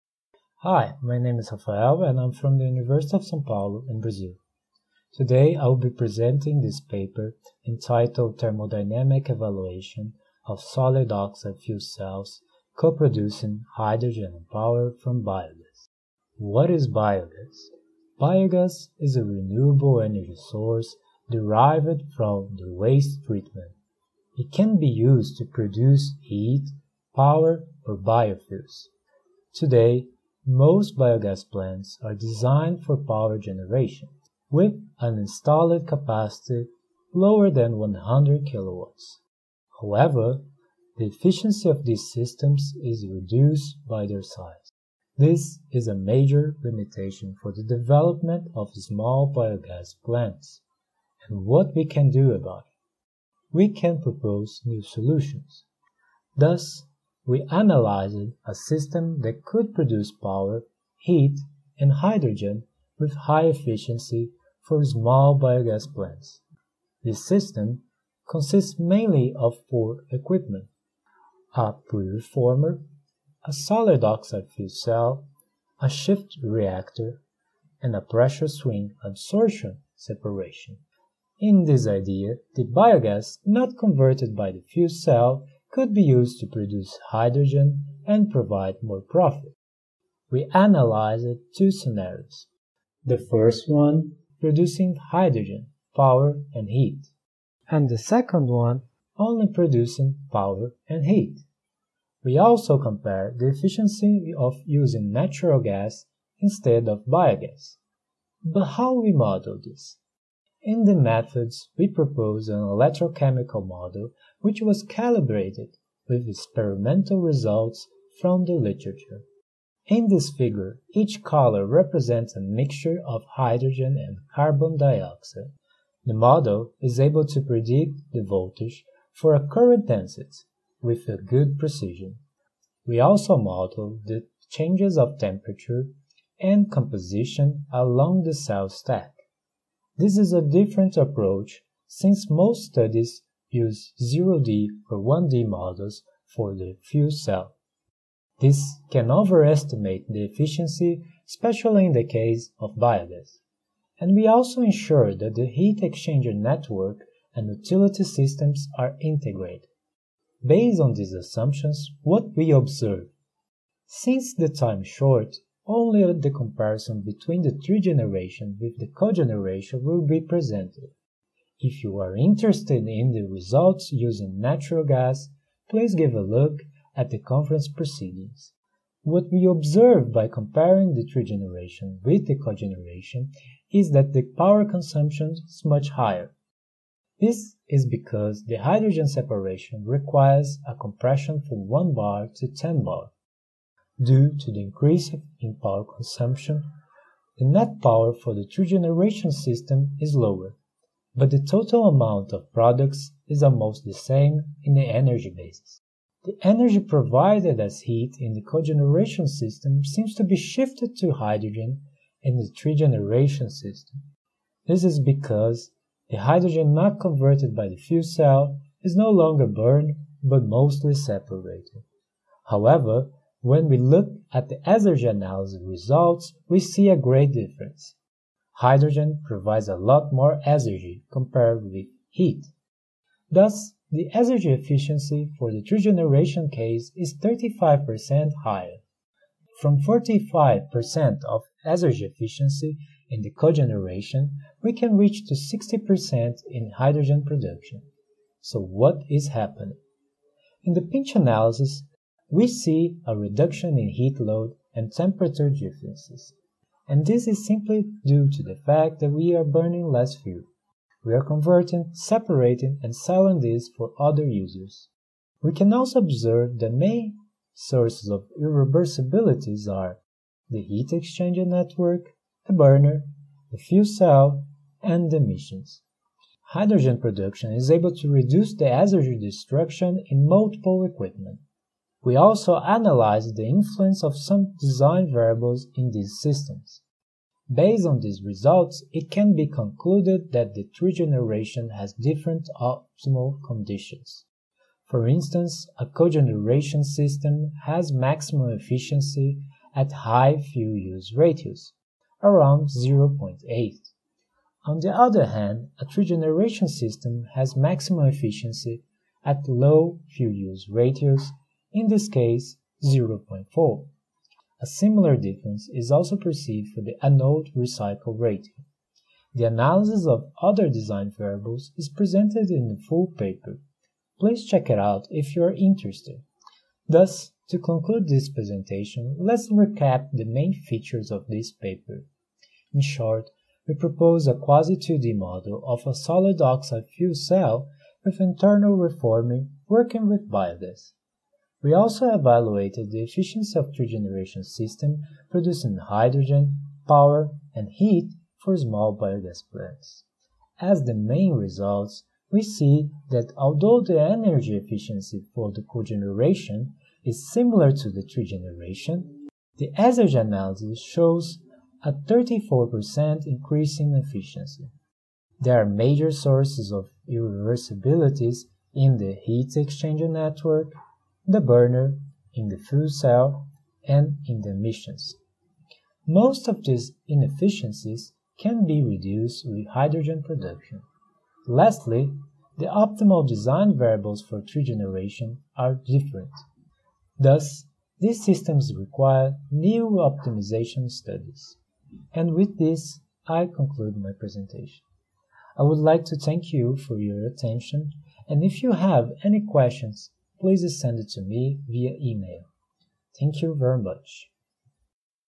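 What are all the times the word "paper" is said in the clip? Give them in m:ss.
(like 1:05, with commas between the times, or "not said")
0:06, 5:23, 5:31.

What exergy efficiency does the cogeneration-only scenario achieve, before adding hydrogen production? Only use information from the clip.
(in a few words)
45%.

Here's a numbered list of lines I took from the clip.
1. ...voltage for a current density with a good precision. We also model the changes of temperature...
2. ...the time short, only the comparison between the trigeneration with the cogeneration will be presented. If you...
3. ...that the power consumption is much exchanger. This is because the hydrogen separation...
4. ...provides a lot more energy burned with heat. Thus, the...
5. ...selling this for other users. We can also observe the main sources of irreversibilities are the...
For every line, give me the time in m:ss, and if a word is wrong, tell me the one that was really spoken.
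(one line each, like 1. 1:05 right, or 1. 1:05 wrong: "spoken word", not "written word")
1. 2:08 right
2. 2:44 right
3. 3:03 wrong: "higher", not "exchanger"
4. 3:49 wrong: "compared", not "burned"
5. 4:22 right.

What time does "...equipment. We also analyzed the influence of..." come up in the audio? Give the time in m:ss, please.
4:40.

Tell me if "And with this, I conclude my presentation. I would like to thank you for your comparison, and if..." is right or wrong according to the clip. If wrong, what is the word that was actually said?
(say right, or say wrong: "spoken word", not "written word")
wrong: "attention", not "comparison".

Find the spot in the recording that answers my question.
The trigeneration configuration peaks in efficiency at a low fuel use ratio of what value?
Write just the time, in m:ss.
5:12.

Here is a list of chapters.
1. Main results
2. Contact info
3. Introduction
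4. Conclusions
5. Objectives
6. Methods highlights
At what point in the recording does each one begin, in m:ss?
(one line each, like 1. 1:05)
1. 2:43
2. 6:31
3. 0:16
4. 5:26
5. 0:53
6. 1:49.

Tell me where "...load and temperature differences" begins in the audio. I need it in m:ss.
4:14.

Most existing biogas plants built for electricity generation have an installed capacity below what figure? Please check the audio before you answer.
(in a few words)
100 kilowatts.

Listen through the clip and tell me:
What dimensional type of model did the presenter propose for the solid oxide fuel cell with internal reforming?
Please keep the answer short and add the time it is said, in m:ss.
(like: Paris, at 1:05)
quasi-2D, at 5:34.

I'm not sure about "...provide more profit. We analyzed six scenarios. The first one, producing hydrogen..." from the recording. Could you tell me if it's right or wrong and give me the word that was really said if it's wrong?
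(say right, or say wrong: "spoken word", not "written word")
wrong: "two", not "six".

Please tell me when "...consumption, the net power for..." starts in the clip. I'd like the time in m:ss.
3:15.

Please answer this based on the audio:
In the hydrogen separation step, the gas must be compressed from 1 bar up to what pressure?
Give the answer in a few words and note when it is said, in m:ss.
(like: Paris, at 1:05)
10 bar, at 3:12.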